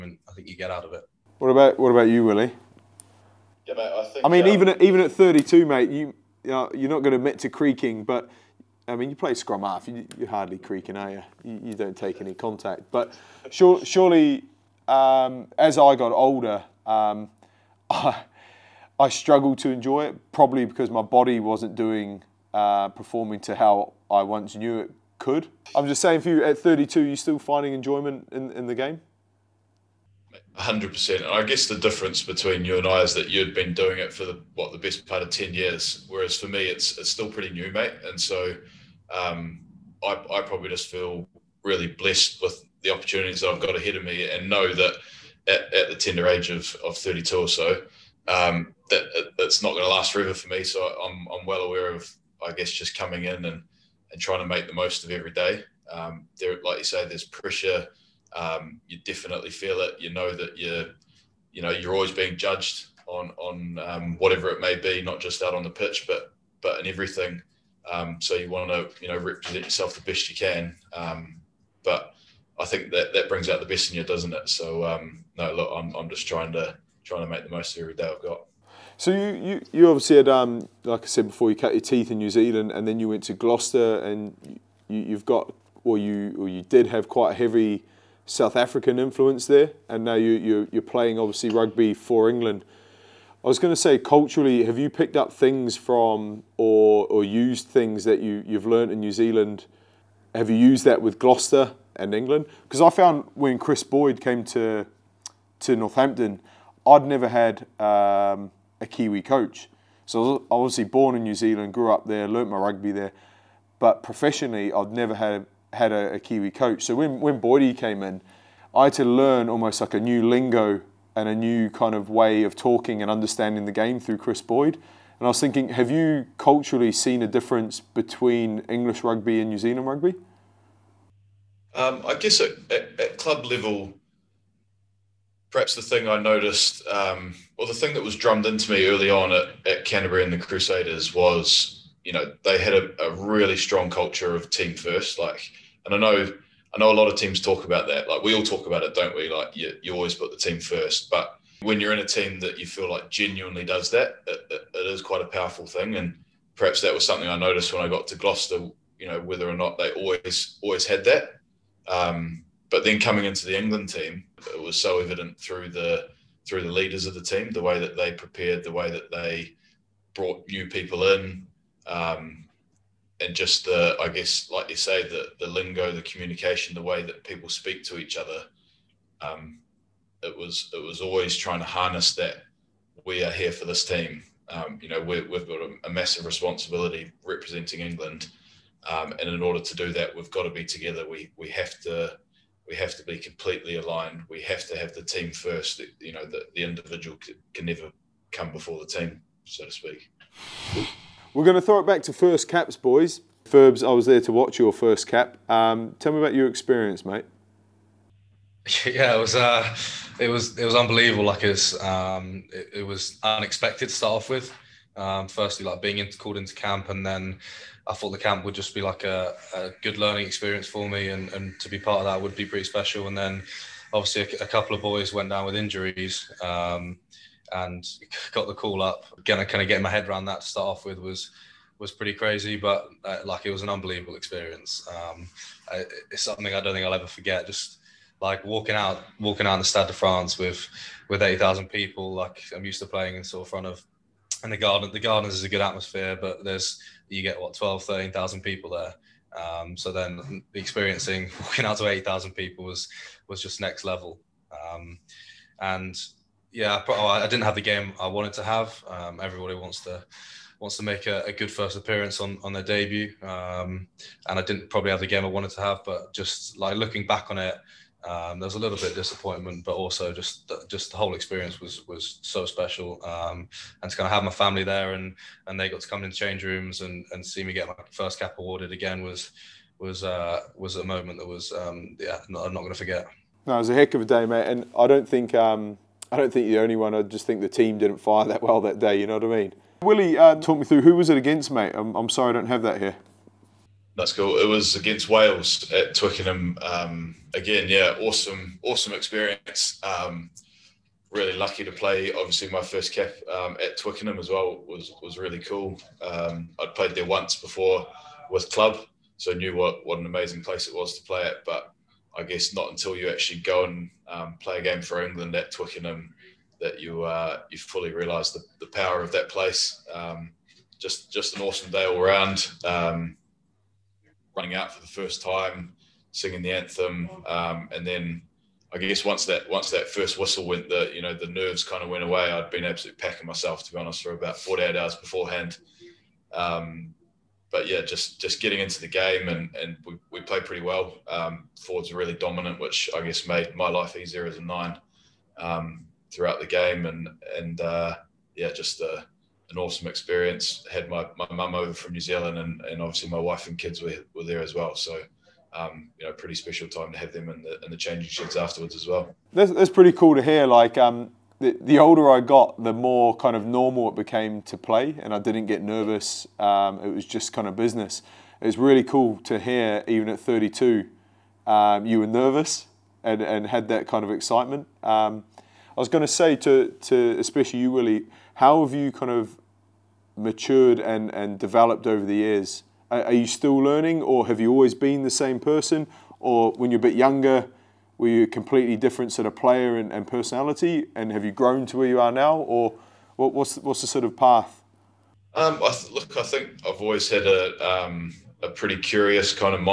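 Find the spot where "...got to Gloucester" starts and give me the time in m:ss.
2:37.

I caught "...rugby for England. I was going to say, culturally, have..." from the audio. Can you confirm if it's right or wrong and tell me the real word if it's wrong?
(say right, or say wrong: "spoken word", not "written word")
right.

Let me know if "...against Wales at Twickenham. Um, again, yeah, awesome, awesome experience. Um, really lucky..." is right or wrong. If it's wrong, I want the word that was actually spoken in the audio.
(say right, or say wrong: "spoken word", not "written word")
right.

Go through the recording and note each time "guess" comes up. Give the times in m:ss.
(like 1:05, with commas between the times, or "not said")
0:31, 0:52, 2:12, 2:54, 5:12, 5:28, 5:42.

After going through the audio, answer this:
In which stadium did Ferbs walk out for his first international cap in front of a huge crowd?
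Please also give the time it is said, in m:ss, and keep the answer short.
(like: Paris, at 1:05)
Stade de France, at 3:59.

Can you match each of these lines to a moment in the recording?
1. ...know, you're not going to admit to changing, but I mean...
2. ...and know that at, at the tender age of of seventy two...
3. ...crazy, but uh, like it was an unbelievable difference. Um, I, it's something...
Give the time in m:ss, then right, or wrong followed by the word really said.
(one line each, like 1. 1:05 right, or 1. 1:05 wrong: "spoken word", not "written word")
1. 0:06 wrong: "creaking", not "changing"
2. 0:44 wrong: "thirty", not "seventy"
3. 3:52 wrong: "experience", not "difference".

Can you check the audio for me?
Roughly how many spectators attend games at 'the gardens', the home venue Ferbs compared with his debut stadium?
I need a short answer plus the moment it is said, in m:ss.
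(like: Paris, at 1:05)
12,000 to 13,000, at 4:07.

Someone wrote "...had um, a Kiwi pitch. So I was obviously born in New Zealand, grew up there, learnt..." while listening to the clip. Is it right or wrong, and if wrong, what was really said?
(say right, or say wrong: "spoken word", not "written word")
wrong: "coach", not "pitch".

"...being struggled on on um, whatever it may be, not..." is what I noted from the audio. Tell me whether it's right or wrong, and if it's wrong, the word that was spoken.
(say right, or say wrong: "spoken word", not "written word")
wrong: "judged", not "struggled".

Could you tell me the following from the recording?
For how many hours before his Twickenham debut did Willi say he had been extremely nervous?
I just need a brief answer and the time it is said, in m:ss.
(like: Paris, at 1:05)
48, at 5:34.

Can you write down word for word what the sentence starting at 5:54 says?
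So um, you know, pretty special time to have them in the, in the changing sheds afterwards as well.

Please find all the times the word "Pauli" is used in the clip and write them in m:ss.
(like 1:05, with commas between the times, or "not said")
not said.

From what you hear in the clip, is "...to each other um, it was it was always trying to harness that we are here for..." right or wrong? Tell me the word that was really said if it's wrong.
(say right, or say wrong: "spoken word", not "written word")
right.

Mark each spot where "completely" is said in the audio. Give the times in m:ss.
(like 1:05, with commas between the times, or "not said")
3:13, 6:28.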